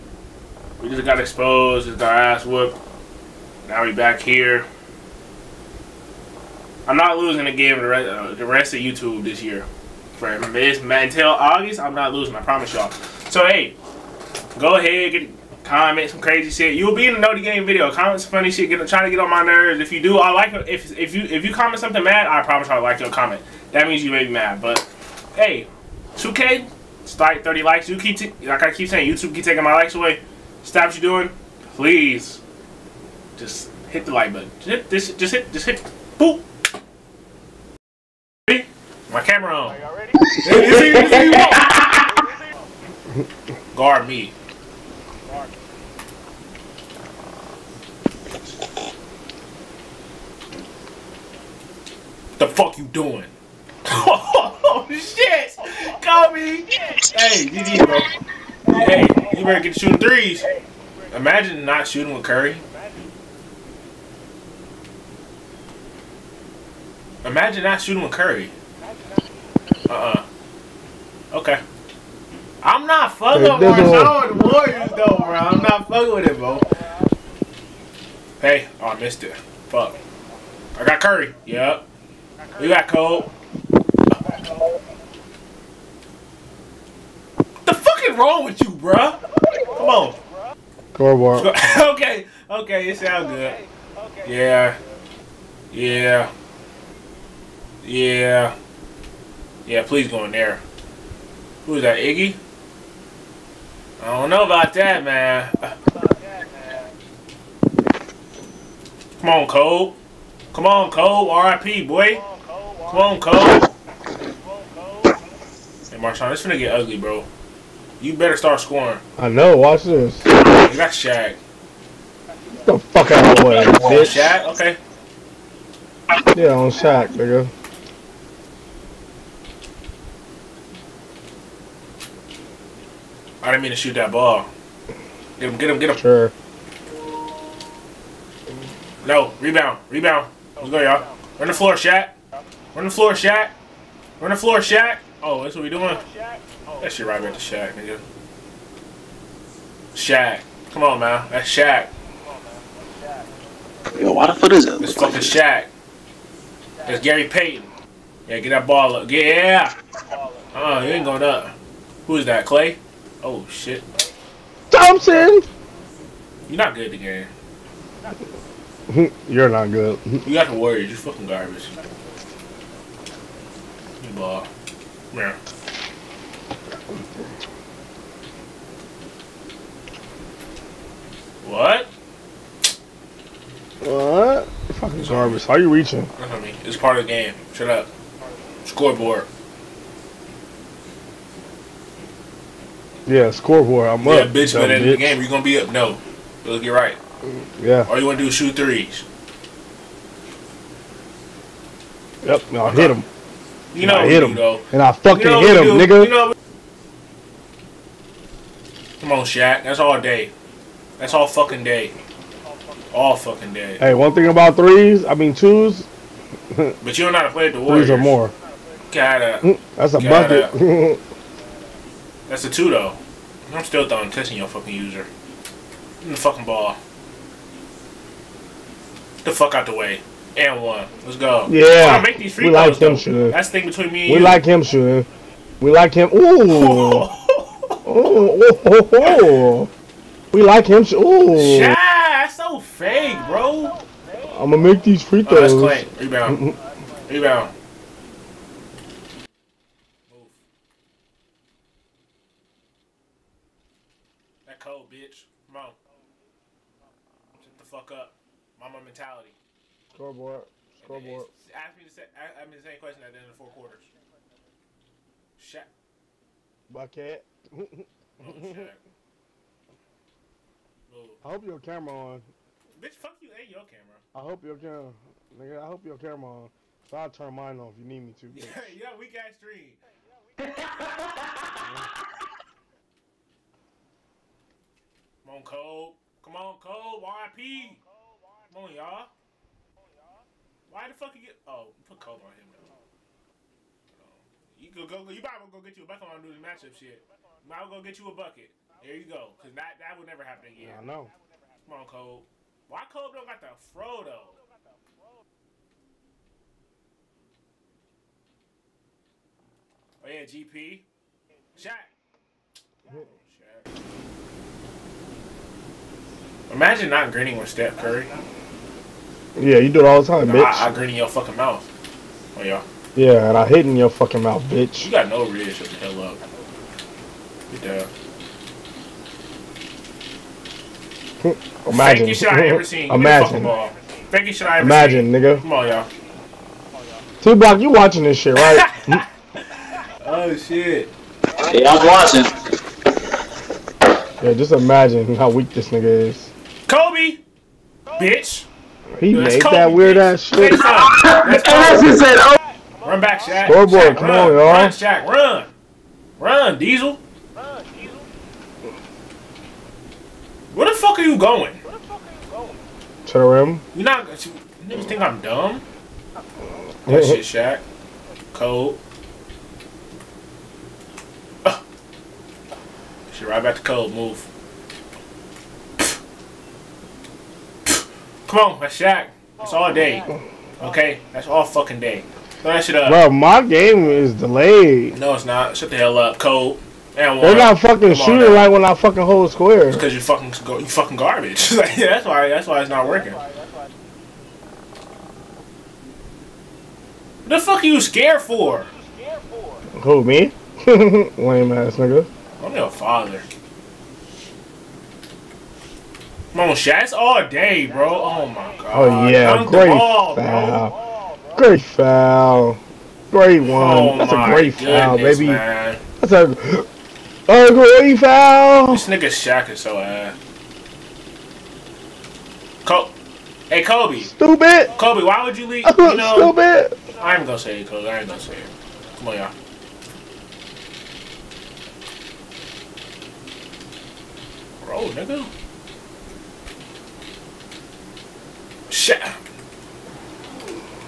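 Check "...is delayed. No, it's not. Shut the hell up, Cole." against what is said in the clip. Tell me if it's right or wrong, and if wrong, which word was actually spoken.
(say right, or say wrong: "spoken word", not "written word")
right.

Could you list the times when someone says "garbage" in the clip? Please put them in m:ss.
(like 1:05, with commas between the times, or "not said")
2:51, 3:05, 6:30.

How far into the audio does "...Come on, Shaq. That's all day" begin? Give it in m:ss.
3:29.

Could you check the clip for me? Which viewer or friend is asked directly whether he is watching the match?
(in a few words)
T Block.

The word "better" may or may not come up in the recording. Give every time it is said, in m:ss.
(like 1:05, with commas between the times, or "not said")
0:59, 1:58.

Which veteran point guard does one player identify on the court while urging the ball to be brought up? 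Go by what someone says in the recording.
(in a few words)
Gary Payton.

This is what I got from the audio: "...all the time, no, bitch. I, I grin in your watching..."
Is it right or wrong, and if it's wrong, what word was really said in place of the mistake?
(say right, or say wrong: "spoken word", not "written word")
wrong: "fucking", not "watching".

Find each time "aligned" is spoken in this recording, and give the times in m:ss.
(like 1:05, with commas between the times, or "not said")
not said.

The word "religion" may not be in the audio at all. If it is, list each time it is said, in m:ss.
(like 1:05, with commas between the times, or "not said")
not said.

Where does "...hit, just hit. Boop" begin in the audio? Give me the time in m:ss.
0:35.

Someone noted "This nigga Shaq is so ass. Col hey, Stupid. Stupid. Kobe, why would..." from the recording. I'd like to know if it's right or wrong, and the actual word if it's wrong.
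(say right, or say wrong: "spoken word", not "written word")
wrong: "Kobe", not "Stupid".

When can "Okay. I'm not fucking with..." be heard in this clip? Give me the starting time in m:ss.
1:11.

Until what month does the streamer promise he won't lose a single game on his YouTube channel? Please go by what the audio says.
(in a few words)
August.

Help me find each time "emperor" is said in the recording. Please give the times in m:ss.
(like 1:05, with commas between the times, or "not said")
not said.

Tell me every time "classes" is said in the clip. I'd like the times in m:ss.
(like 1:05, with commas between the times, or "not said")
not said.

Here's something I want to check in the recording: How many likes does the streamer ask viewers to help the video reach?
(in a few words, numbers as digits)
30.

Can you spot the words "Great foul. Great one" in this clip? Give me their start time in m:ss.
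6:51.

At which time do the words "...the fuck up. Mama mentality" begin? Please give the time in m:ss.
4:17.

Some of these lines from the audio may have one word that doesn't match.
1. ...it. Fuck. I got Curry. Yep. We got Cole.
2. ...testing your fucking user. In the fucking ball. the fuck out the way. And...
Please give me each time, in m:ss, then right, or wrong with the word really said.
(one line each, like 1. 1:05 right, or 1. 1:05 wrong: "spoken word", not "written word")
1. 1:19 right
2. 3:44 right.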